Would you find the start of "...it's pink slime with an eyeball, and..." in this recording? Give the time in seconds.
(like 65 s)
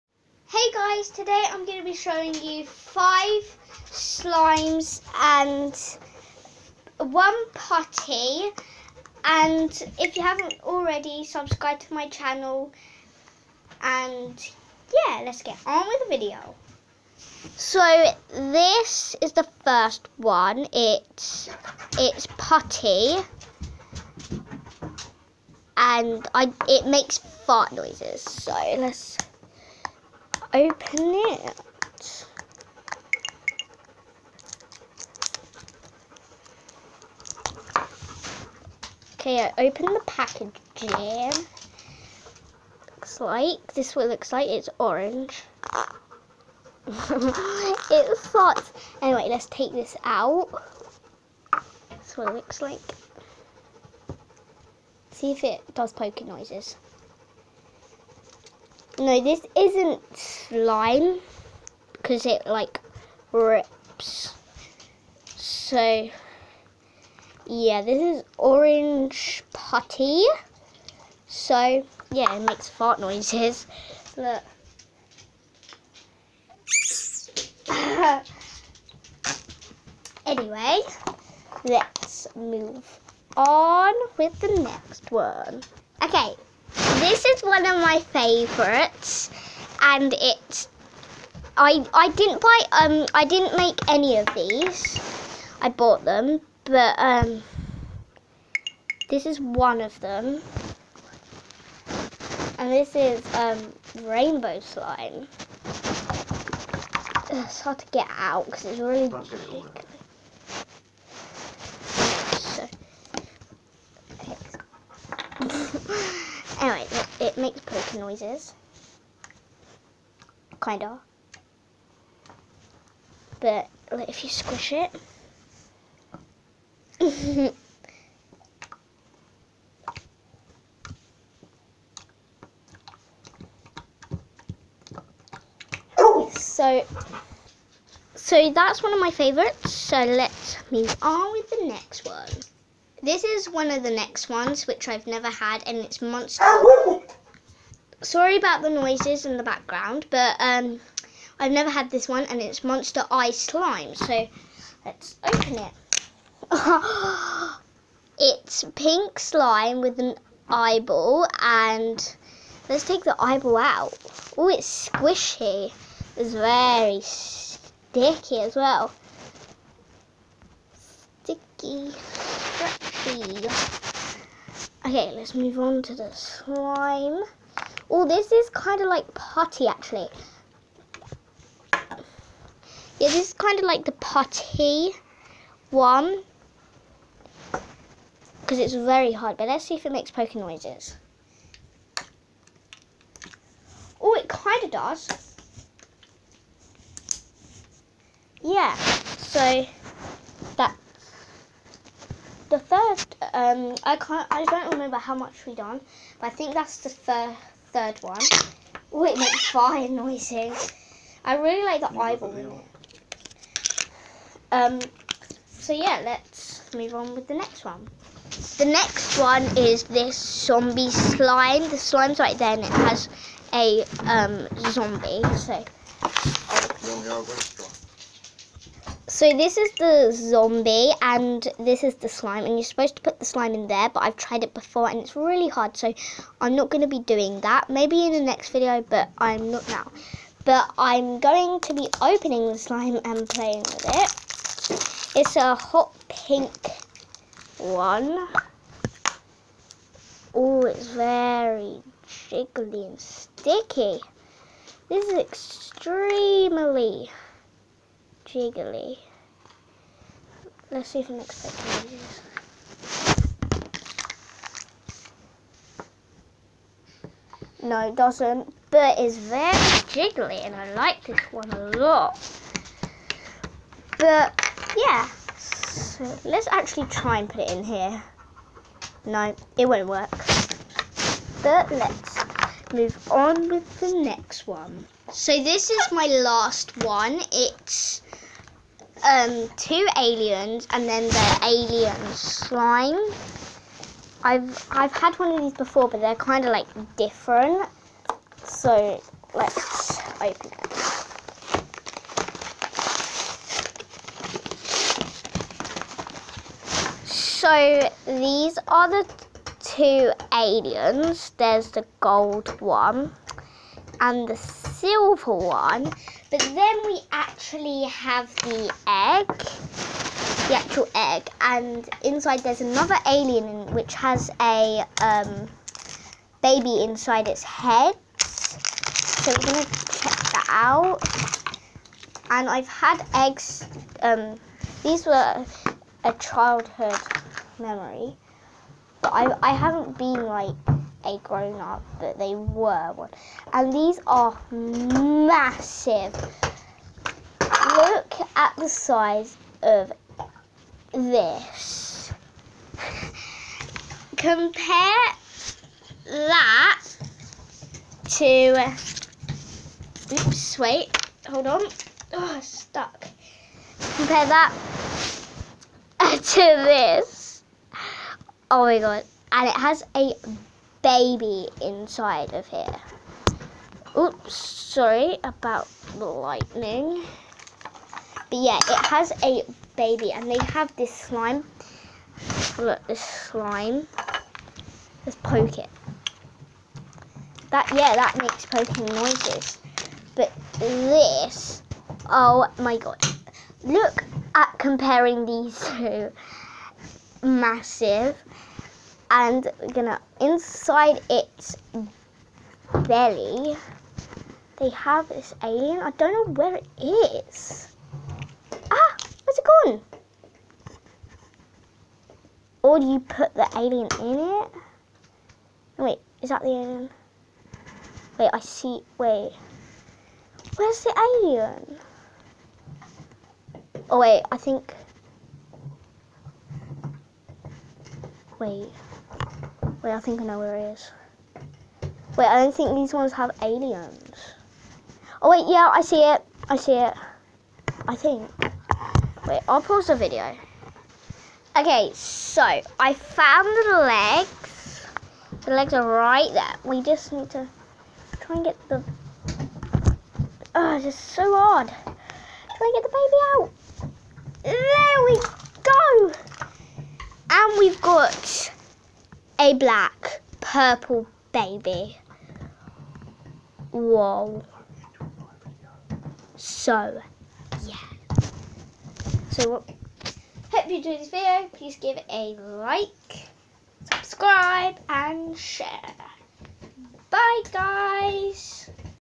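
158 s.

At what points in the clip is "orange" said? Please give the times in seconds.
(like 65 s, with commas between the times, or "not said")
44 s, 68 s.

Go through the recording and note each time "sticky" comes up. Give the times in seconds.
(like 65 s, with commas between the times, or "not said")
167 s, 171 s, 252 s.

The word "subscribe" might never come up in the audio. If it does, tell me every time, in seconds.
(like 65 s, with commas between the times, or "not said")
11 s, 473 s.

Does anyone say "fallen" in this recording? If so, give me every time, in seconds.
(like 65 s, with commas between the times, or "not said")
not said.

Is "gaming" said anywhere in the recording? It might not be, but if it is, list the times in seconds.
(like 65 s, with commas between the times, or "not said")
not said.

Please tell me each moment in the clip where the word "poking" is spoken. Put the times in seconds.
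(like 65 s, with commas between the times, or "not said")
55 s, 388 s.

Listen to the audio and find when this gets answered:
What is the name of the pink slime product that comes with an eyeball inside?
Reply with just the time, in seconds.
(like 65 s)
152 s.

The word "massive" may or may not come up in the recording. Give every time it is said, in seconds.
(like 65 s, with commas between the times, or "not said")
344 s, 397 s.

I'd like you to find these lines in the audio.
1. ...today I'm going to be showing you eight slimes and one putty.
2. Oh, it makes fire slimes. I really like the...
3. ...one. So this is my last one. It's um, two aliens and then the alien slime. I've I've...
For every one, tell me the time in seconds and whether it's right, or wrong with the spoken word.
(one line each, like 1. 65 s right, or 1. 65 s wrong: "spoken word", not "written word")
1. 1 s wrong: "five", not "eight"
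2. 208 s wrong: "noises", not "slimes"
3. 284 s right.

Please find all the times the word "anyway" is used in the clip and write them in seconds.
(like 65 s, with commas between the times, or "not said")
49 s, 80 s.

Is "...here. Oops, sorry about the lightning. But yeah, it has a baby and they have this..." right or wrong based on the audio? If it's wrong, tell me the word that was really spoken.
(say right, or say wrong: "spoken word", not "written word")
right.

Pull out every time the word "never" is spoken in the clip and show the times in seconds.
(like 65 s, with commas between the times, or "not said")
145 s, 151 s.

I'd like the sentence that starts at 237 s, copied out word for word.
Maybe in the next video but I'm not now.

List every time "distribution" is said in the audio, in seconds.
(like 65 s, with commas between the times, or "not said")
not said.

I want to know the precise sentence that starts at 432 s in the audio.
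Wait, I don't think these ones have aliens.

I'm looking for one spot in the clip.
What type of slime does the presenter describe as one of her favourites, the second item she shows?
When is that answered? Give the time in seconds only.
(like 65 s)
104 s.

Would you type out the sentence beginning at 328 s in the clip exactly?
So we're gonna check that out.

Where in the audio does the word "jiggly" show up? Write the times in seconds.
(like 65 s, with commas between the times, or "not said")
252 s, 258 s, 269 s.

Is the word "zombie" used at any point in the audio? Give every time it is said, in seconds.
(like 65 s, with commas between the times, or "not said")
220 s, 224 s, 230 s.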